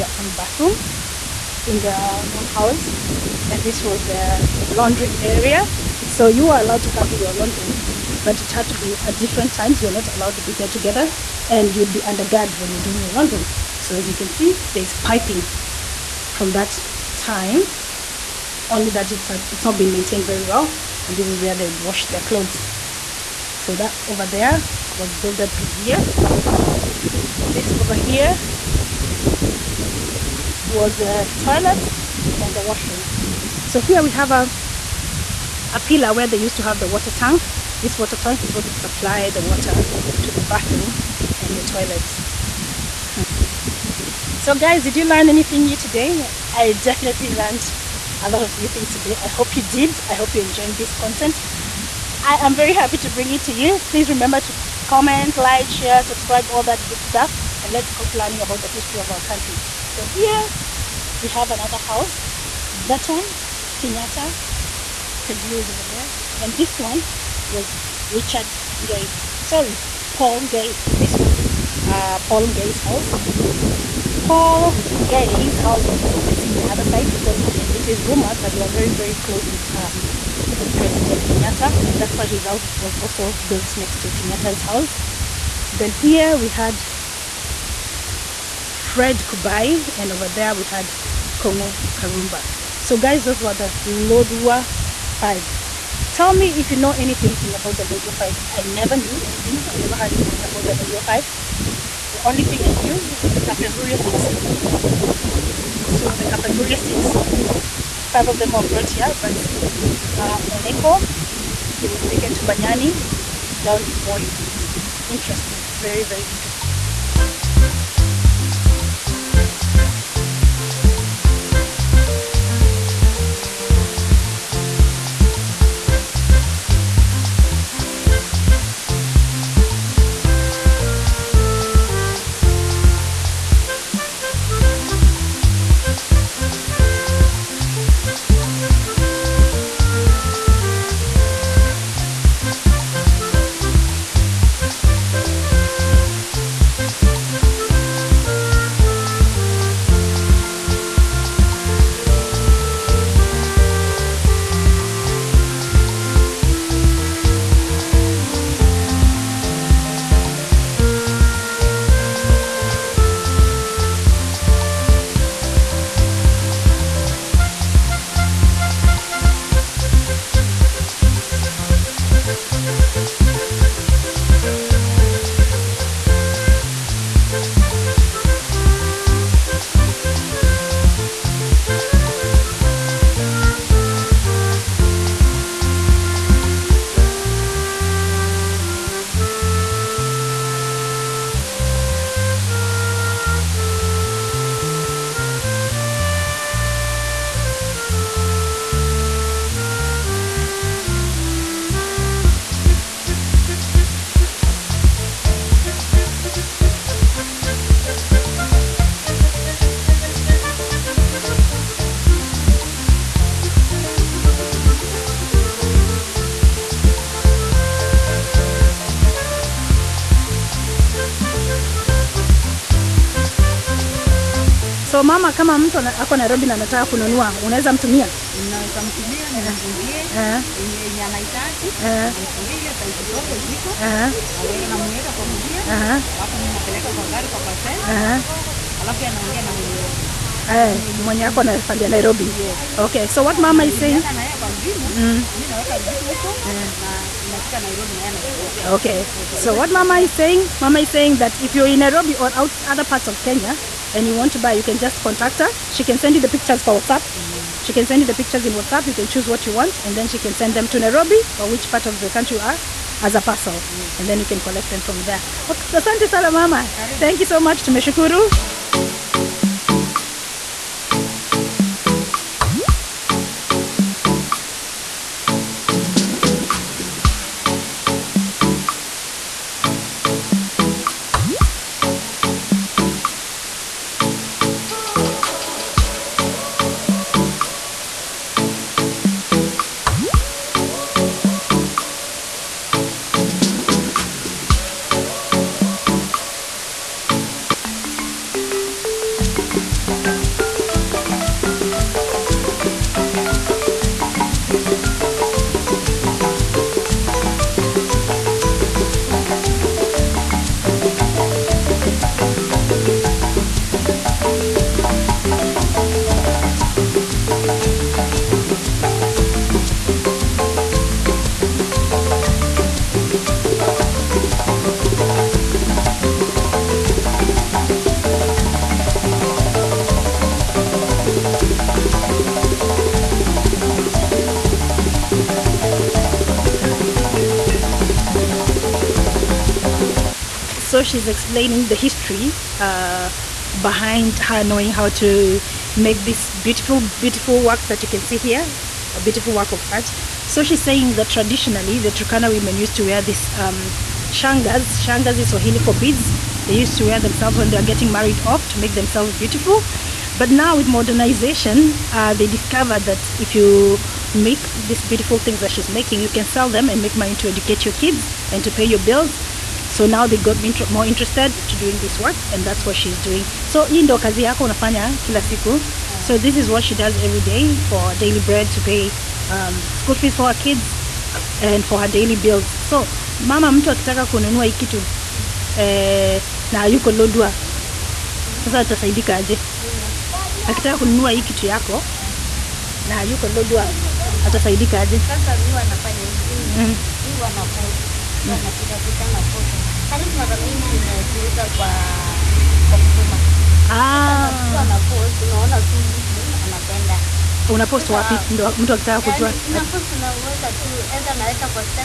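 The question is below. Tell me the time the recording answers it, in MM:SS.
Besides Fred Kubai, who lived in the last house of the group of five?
01:31.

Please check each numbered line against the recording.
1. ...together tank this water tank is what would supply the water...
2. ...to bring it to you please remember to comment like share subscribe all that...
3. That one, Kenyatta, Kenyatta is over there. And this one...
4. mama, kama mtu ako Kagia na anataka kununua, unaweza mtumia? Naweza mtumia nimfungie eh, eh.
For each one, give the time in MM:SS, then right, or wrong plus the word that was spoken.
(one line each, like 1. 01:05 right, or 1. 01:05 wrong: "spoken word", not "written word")
1. 00:36 wrong: "water", not "together"
2. 00:52 right
3. 01:02 wrong: "Kagia", not "Kenyatta"
4. 03:45 wrong: "Nairobi", not "Kagia".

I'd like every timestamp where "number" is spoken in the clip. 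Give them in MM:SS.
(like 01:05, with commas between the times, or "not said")
not said.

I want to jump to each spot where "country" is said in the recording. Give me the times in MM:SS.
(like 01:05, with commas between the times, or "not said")
00:59, 04:22.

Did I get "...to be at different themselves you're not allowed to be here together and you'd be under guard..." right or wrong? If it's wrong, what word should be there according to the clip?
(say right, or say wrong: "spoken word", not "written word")
wrong: "times", not "themselves".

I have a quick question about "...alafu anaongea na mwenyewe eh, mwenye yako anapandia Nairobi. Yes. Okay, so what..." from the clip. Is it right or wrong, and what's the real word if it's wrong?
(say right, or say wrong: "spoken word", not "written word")
right.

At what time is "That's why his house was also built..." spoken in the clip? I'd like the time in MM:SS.
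01:21.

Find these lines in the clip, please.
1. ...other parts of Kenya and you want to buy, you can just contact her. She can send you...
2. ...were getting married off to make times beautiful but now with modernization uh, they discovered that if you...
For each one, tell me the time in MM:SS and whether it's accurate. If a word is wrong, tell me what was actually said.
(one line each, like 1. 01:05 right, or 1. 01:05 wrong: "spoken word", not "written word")
1. 04:12 right
2. 05:57 wrong: "themselves", not "times".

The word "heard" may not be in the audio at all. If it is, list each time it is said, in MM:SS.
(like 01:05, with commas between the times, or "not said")
01:39.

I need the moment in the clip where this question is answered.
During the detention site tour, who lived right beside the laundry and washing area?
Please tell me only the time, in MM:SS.
00:25.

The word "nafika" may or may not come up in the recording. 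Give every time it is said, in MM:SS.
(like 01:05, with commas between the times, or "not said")
04:07.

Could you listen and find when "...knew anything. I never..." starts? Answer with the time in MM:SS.
01:38.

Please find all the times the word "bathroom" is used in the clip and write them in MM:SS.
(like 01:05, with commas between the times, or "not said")
00:00, 00:40.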